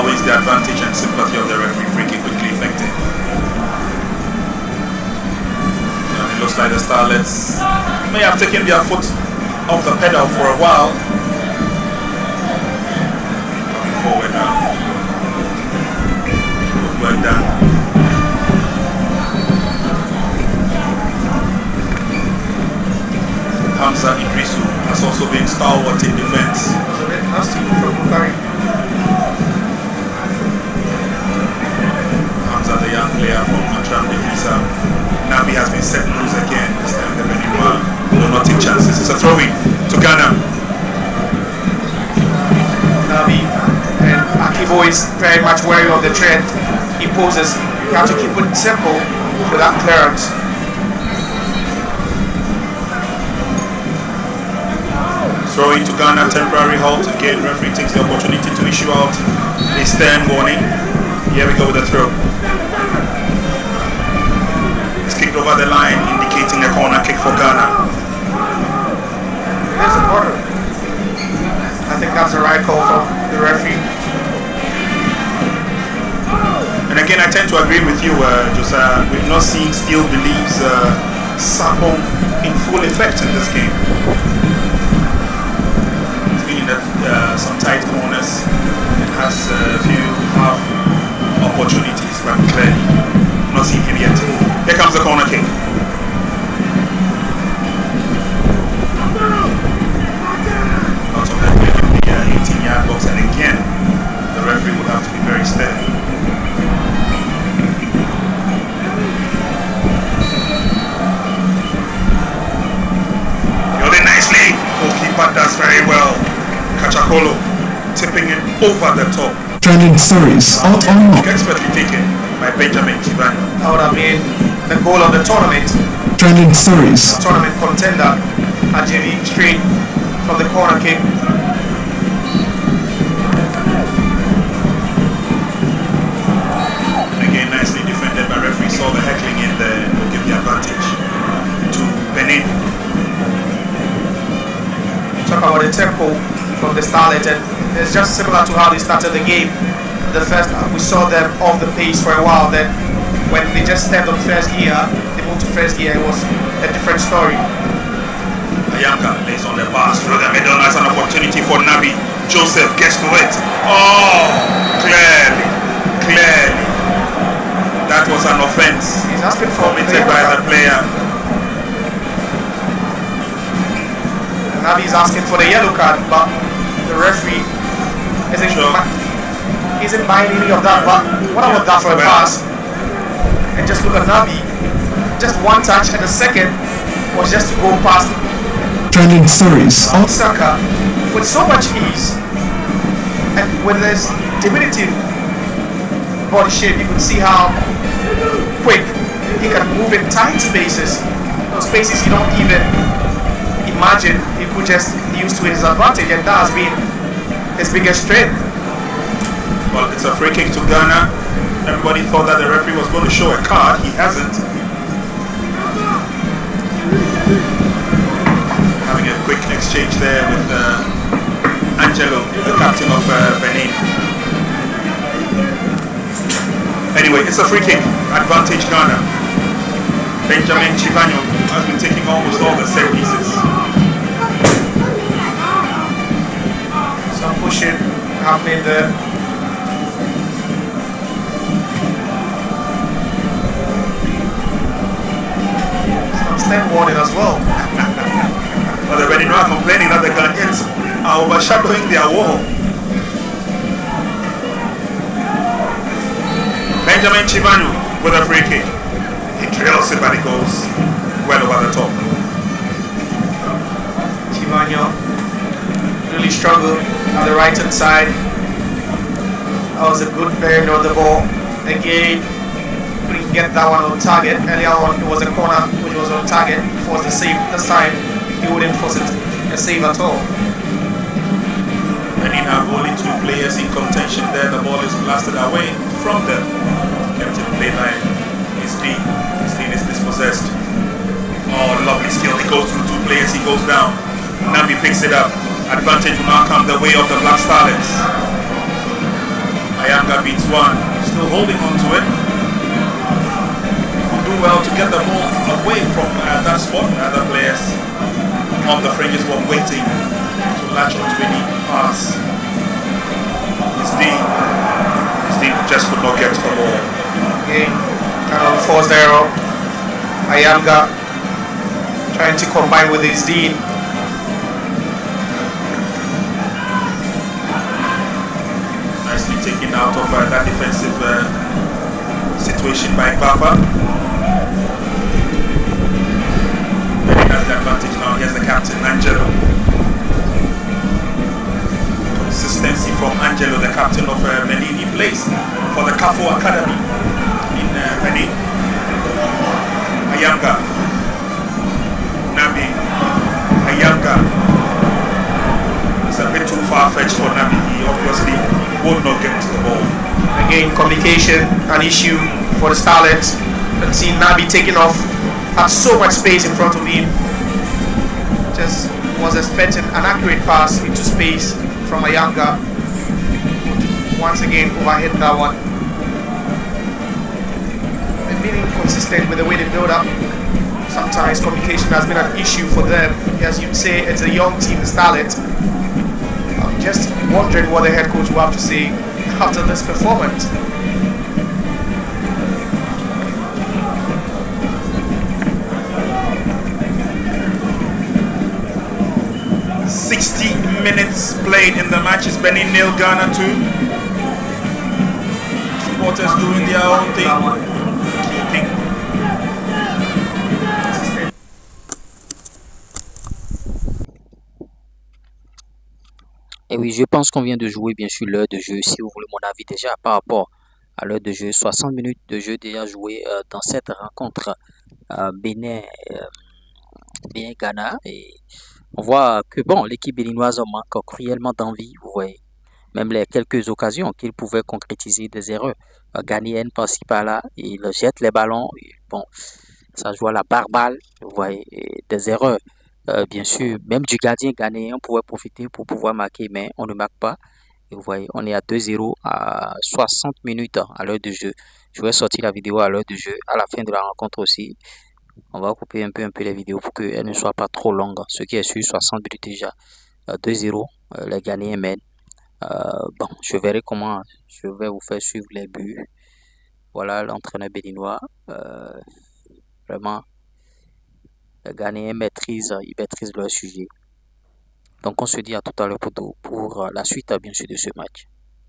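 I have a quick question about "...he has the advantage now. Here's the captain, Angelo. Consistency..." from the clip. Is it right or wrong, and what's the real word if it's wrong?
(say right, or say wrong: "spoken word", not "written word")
right.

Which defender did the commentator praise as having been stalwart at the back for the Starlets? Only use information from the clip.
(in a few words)
Hamza Idrisu.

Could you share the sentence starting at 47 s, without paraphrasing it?
You have to keep it simple without clearance.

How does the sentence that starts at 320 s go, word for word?
Ayanga trying to combine with his dean taken out of uh, that defensive uh, situation by Papa.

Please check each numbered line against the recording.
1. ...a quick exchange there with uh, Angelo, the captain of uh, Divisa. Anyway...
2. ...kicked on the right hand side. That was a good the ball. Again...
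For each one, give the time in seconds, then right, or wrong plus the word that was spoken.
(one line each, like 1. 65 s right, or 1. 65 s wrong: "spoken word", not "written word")
1. 219 s wrong: "Benin", not "Divisa"
2. 266 s wrong: "struggled", not "kicked".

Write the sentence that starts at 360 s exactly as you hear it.
Again, communication, an issue for the Starlets.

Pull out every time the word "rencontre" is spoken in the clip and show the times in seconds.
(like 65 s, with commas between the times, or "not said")
423 s, 454 s.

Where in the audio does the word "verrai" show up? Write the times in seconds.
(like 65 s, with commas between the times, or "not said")
463 s.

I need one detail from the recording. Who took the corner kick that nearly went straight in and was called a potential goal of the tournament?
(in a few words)
Benjamin Kiban.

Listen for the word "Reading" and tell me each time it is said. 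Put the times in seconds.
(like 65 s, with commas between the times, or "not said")
249 s.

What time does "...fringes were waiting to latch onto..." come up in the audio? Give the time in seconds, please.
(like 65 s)
308 s.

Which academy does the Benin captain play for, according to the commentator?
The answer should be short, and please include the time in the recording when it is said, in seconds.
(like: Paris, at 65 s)
Kafu Academy, at 345 s.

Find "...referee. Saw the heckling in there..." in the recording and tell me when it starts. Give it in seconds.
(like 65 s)
138 s.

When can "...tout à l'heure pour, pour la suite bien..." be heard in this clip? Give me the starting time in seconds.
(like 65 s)
475 s.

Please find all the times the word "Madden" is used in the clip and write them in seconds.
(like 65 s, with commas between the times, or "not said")
not said.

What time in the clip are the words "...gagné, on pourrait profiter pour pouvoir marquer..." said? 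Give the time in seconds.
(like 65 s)
444 s.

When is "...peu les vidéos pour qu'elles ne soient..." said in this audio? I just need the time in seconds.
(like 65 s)
456 s.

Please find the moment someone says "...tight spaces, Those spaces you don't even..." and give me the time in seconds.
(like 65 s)
200 s.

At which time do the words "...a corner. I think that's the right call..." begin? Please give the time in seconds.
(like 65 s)
69 s.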